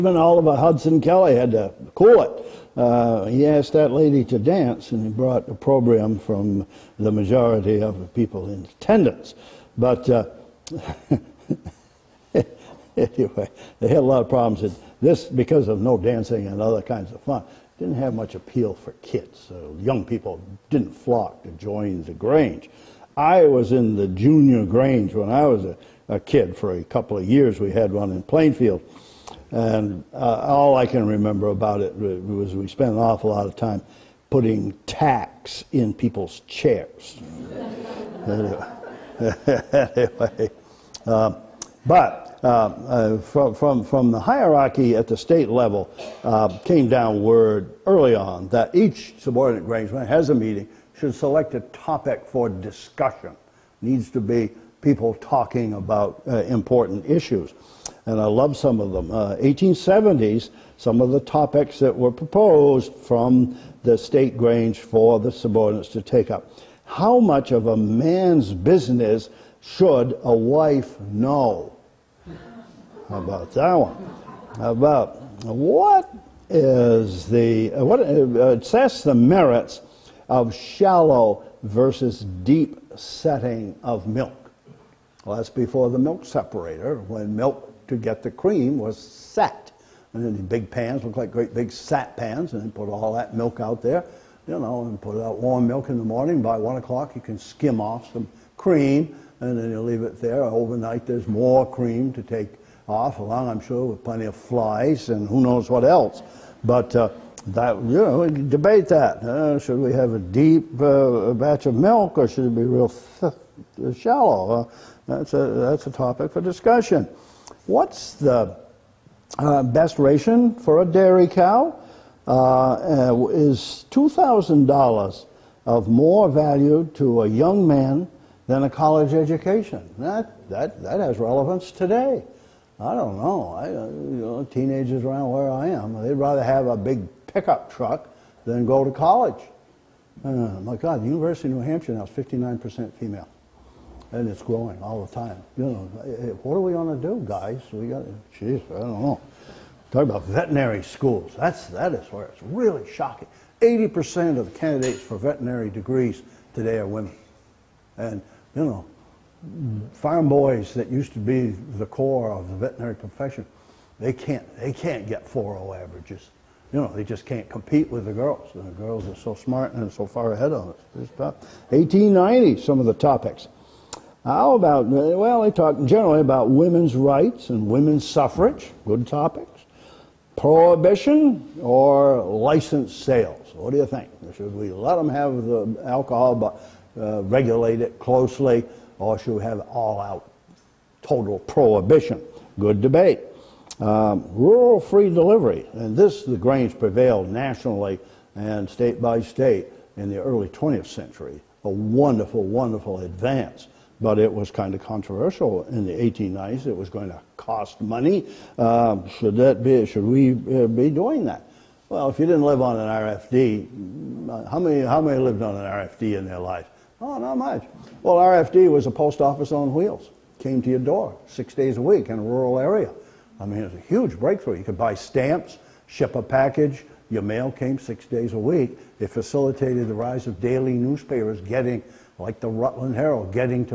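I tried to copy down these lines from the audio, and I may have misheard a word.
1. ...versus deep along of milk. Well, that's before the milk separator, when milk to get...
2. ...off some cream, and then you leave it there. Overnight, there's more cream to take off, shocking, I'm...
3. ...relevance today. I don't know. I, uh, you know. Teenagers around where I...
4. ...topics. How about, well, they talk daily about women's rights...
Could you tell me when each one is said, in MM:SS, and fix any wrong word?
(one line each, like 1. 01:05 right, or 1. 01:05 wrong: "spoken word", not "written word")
1. 01:21 wrong: "setting", not "along"
2. 01:37 wrong: "along", not "shocking"
3. 02:11 right
4. 02:52 wrong: "generally", not "daily".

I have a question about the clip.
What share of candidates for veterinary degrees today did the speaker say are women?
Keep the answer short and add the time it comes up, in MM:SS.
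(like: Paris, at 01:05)
80%, at 02:33.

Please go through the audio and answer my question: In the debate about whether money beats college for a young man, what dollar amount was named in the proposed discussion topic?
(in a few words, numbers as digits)
$2,000.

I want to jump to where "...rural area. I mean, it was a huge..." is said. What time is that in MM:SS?
03:42.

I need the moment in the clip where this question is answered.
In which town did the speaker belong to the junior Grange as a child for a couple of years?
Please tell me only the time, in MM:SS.
00:28.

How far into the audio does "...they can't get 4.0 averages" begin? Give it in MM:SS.
02:44.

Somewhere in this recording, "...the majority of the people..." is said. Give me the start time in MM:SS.
00:06.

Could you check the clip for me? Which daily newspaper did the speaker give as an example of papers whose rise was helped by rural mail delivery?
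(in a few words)
Rutland Herald.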